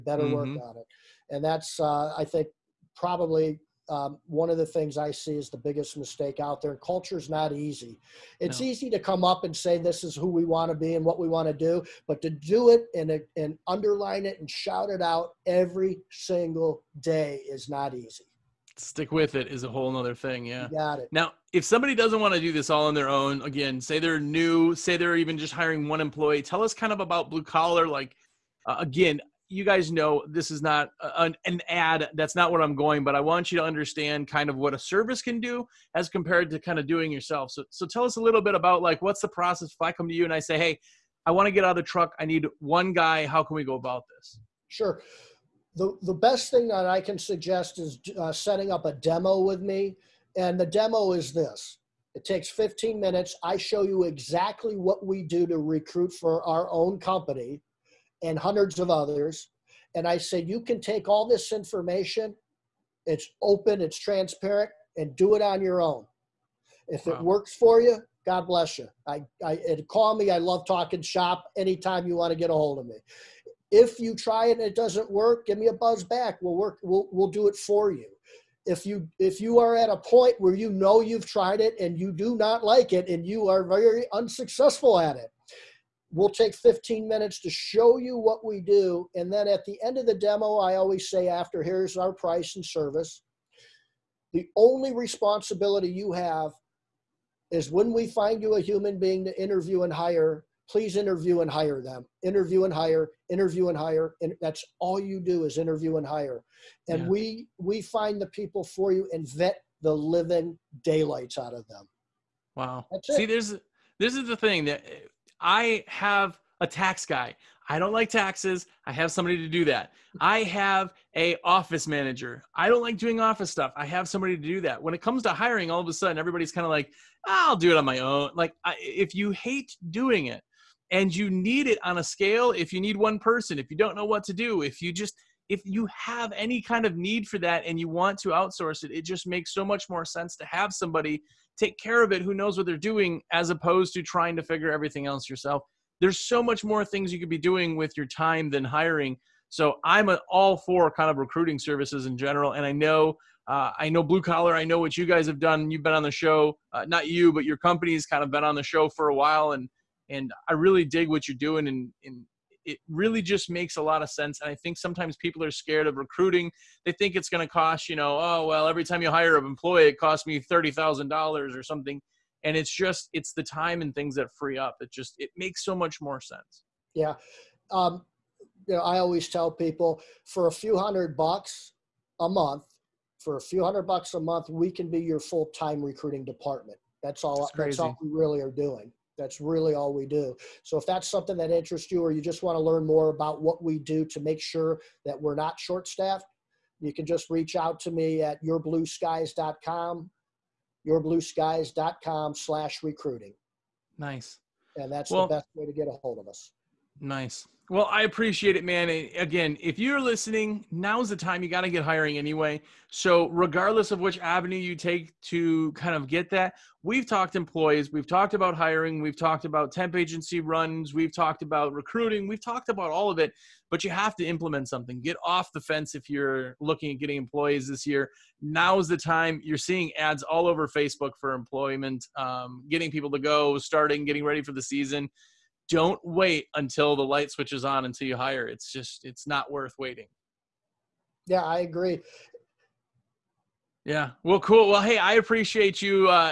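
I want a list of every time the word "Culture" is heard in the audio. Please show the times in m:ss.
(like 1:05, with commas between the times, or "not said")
0:06.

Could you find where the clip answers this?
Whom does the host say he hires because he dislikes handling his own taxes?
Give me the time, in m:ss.
1:56.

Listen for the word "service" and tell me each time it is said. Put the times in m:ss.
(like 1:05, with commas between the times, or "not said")
0:34, 1:32, 2:31.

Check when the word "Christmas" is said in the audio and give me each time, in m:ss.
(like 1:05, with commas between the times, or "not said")
not said.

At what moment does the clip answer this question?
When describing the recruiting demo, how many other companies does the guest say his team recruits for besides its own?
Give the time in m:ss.
0:58.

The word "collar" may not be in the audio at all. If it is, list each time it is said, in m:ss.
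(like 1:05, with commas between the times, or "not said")
0:27, 2:34.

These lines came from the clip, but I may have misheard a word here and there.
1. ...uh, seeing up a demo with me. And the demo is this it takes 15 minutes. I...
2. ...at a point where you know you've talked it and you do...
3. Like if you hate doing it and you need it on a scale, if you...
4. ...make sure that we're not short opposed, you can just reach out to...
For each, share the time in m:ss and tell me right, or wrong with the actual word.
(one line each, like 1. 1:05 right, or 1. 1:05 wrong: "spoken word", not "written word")
1. 0:48 wrong: "setting", not "seeing"
2. 1:19 wrong: "tried", not "talked"
3. 2:08 right
4. 3:14 wrong: "staffed", not "opposed".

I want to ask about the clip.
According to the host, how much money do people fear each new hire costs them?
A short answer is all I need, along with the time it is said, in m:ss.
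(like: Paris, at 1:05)
$30,000, at 2:50.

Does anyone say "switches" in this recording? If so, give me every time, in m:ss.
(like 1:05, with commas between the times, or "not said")
3:57.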